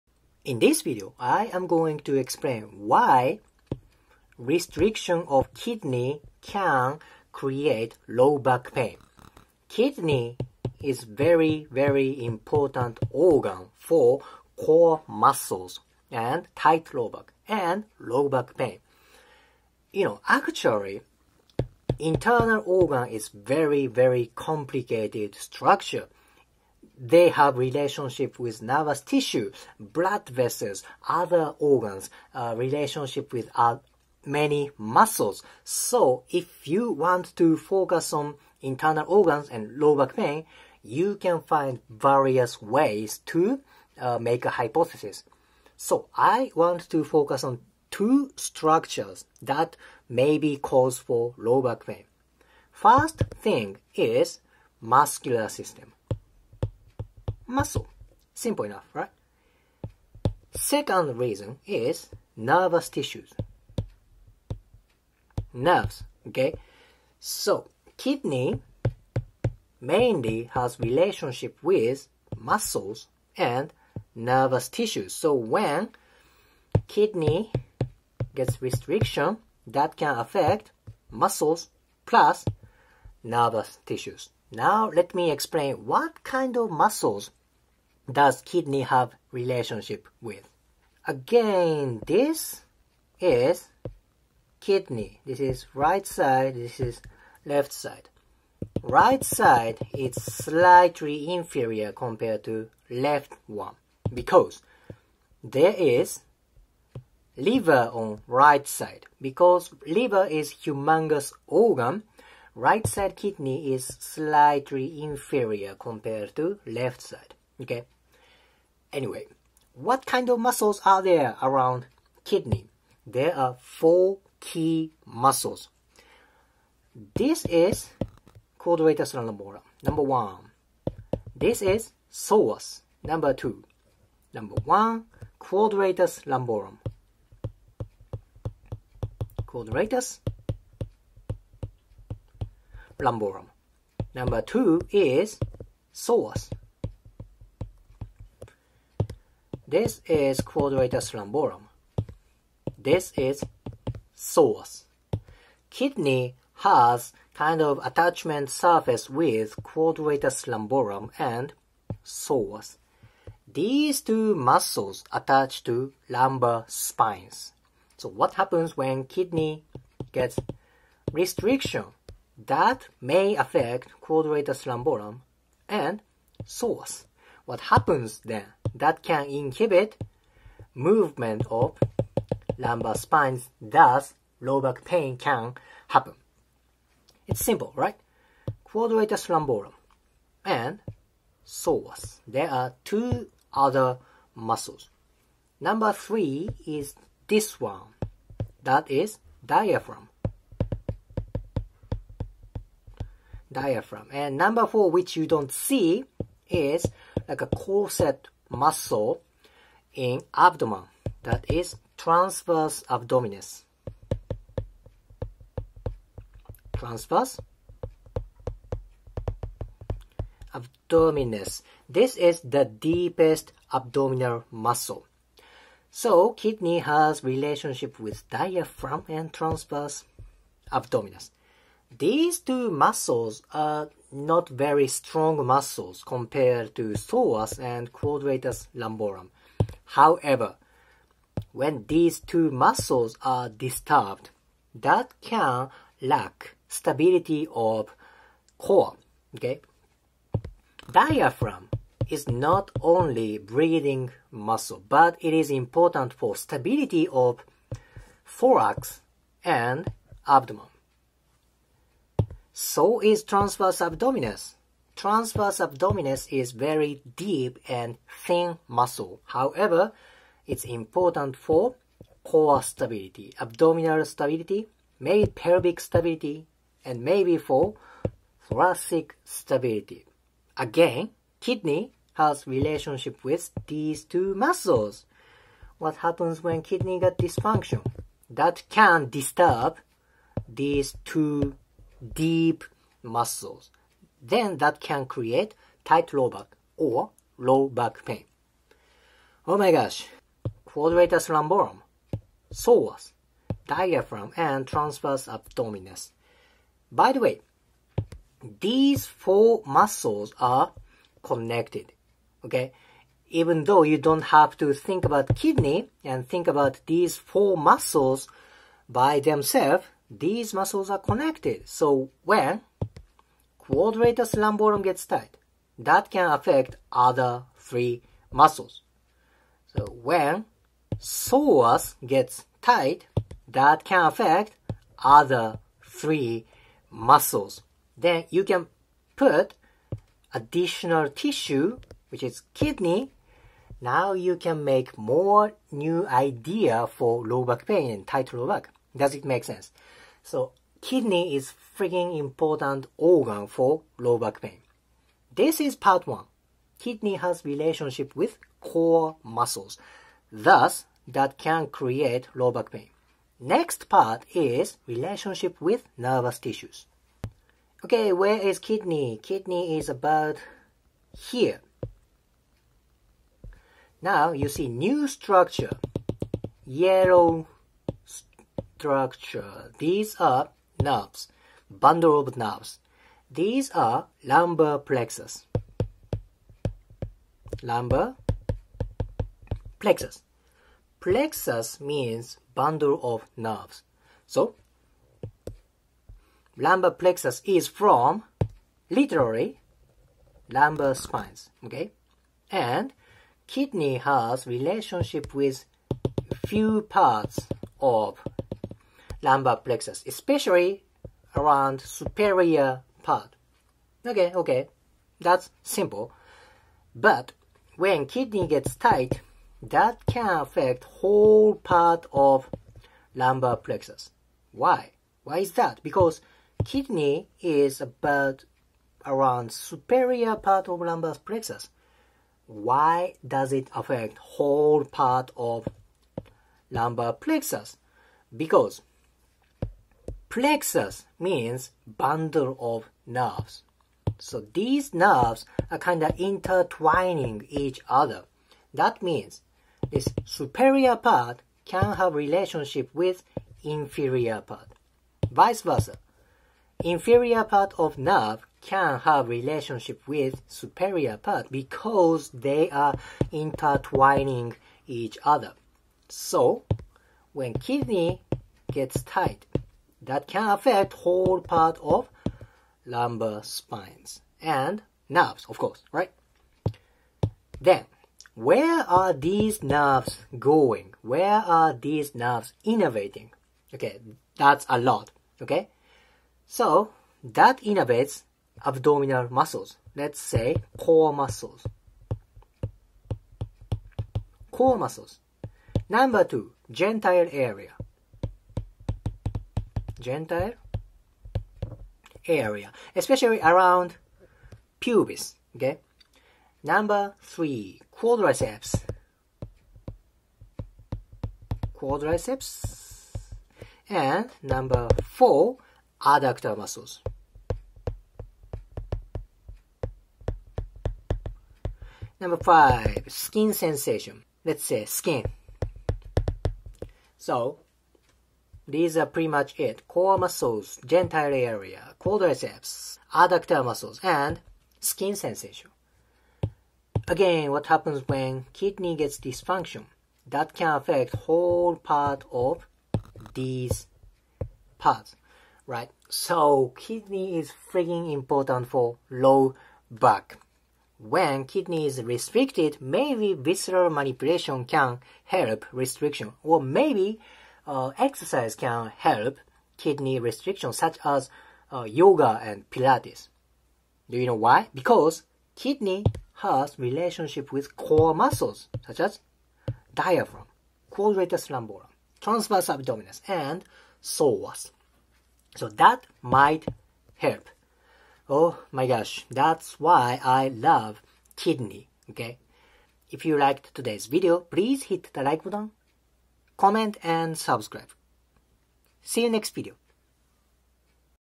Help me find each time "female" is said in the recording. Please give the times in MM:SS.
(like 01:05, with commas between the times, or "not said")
not said.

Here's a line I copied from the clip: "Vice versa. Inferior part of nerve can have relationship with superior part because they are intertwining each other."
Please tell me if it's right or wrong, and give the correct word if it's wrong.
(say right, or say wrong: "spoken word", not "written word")
right.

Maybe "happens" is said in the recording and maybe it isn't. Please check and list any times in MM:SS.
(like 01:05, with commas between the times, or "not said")
02:48, 02:57, 03:05, 04:45, 08:57.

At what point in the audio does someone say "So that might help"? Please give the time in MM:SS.
09:35.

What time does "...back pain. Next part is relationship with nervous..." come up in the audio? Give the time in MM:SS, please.
06:02.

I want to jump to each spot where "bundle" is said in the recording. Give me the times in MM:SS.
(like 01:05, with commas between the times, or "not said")
06:21, 06:32, 07:21.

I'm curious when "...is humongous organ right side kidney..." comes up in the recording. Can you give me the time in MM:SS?
01:50.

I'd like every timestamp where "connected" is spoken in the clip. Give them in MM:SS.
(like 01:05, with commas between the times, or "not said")
05:11, 05:20.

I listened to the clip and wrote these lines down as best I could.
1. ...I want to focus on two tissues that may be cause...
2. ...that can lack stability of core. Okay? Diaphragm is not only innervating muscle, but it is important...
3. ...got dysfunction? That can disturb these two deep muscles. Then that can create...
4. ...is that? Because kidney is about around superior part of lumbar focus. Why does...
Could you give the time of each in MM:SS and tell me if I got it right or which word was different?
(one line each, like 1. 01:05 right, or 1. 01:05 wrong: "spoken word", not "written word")
1. 00:46 wrong: "structures", not "tissues"
2. 04:04 wrong: "breathing", not "innervating"
3. 04:46 right
4. 07:05 wrong: "plexus", not "focus".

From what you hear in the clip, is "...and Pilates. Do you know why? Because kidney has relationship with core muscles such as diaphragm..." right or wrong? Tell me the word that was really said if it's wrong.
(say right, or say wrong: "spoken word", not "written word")
right.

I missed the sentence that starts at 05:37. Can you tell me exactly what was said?
Then you can put additional tissue, which is kidney.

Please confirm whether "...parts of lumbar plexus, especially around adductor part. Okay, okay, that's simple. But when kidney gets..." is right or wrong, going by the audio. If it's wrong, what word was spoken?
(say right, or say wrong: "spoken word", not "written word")
wrong: "superior", not "adductor".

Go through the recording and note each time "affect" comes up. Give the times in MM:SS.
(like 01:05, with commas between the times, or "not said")
01:20, 02:53, 05:26, 05:34, 07:00, 07:13, 07:50, 09:00.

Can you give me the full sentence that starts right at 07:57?
Then, where are these nerves going?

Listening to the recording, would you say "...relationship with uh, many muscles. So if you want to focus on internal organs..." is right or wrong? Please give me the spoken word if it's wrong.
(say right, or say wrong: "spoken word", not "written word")
right.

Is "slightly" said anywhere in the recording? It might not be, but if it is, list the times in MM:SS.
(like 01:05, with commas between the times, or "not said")
01:40, 01:53.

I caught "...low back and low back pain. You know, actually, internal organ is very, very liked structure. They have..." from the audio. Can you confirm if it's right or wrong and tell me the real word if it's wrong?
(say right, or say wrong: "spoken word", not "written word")
wrong: "complicated", not "liked".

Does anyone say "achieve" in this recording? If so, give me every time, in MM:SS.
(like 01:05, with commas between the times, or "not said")
not said.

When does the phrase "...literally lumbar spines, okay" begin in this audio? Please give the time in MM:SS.
06:38.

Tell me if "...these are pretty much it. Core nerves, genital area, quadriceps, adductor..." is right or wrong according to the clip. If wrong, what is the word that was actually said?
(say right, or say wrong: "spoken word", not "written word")
wrong: "muscles", not "nerves".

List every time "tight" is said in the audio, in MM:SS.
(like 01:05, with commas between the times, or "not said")
00:16, 04:55, 05:25, 05:32, 05:48, 06:58, 07:49.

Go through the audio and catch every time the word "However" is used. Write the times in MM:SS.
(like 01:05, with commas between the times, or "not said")
03:59, 04:29.